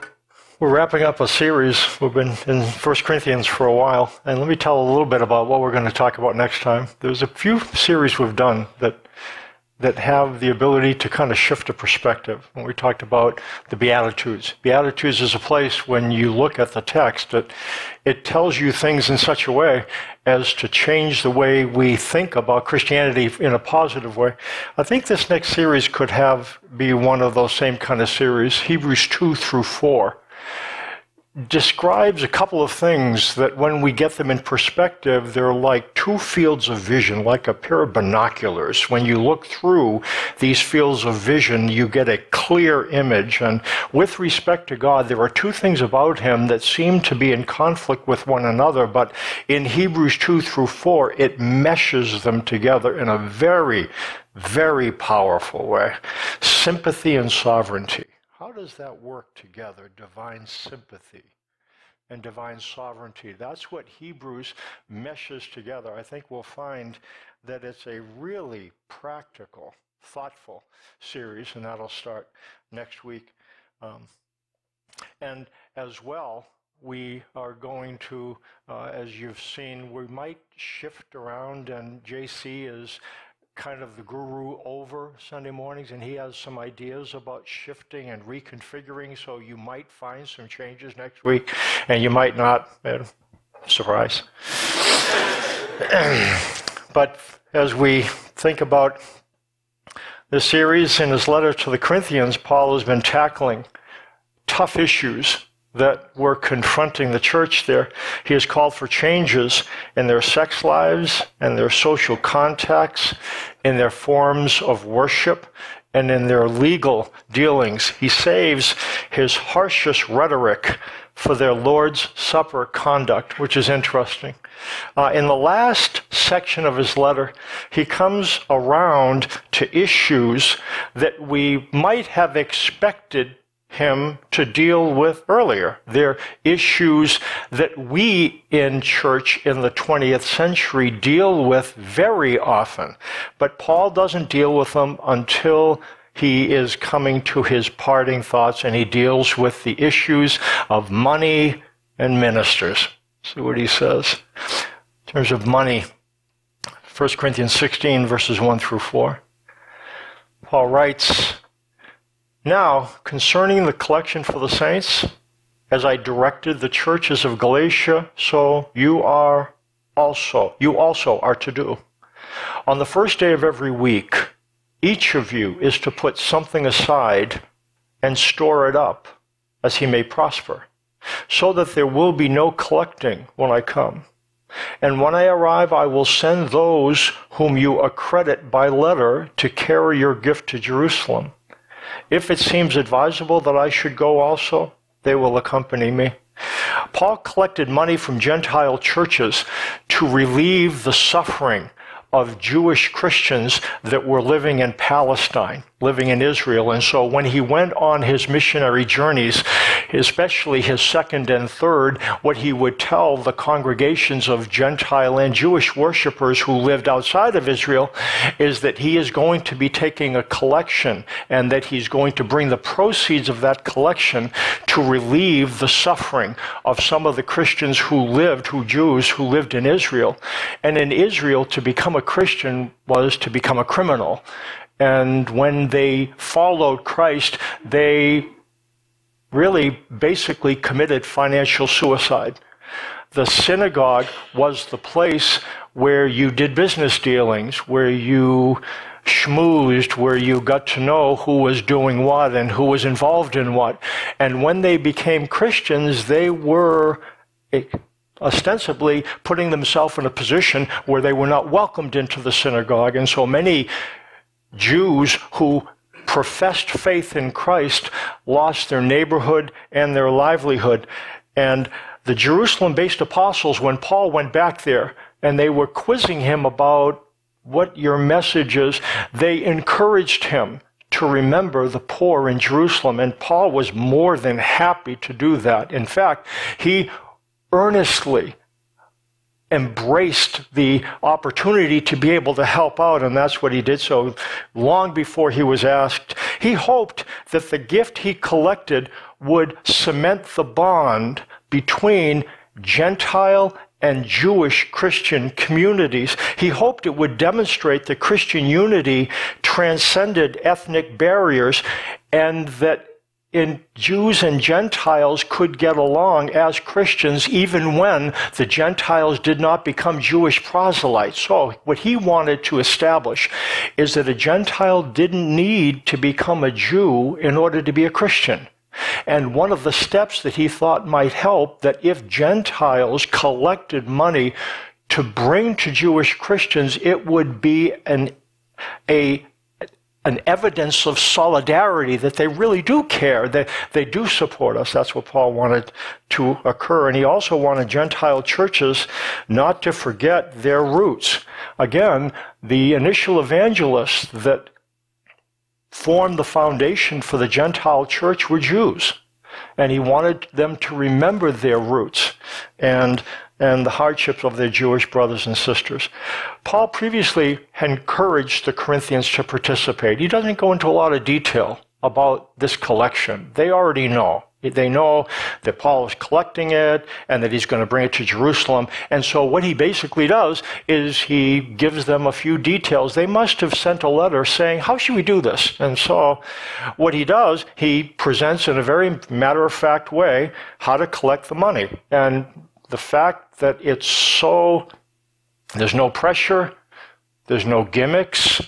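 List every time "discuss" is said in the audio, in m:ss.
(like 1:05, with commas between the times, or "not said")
not said.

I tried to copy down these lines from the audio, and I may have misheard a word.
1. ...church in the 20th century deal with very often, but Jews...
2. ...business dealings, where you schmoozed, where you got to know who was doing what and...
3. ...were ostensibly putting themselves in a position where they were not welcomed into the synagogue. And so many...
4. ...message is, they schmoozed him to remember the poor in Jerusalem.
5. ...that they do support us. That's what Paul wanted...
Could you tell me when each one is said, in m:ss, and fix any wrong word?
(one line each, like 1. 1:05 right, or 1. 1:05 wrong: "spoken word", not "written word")
1. 2:18 wrong: "Paul", not "Jews"
2. 4:06 right
3. 4:16 right
4. 4:37 wrong: "encouraged", not "schmoozed"
5. 5:43 right.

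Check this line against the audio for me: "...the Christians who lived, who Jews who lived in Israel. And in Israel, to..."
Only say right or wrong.
right.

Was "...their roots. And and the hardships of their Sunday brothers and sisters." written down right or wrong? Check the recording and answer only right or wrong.
wrong.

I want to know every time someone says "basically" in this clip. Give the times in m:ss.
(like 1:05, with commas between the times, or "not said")
4:00, 6:19.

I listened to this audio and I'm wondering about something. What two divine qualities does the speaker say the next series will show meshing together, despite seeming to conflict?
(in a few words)
Sympathy and sovereignty.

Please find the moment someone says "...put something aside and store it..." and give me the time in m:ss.
2:55.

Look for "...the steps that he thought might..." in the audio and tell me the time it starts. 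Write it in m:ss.
5:29.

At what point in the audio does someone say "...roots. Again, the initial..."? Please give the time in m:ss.
5:50.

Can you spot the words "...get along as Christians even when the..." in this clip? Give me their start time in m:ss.
5:15.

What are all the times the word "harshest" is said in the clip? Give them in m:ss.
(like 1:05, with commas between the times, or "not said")
1:59.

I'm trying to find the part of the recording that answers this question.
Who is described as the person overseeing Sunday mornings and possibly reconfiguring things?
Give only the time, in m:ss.
1:22.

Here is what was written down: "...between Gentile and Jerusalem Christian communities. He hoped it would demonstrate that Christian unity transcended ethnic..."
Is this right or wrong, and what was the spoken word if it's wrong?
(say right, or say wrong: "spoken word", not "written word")
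wrong: "Jewish", not "Jerusalem".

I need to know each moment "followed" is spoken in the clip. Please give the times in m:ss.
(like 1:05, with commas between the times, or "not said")
3:56.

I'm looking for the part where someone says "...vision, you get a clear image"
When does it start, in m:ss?
0:41.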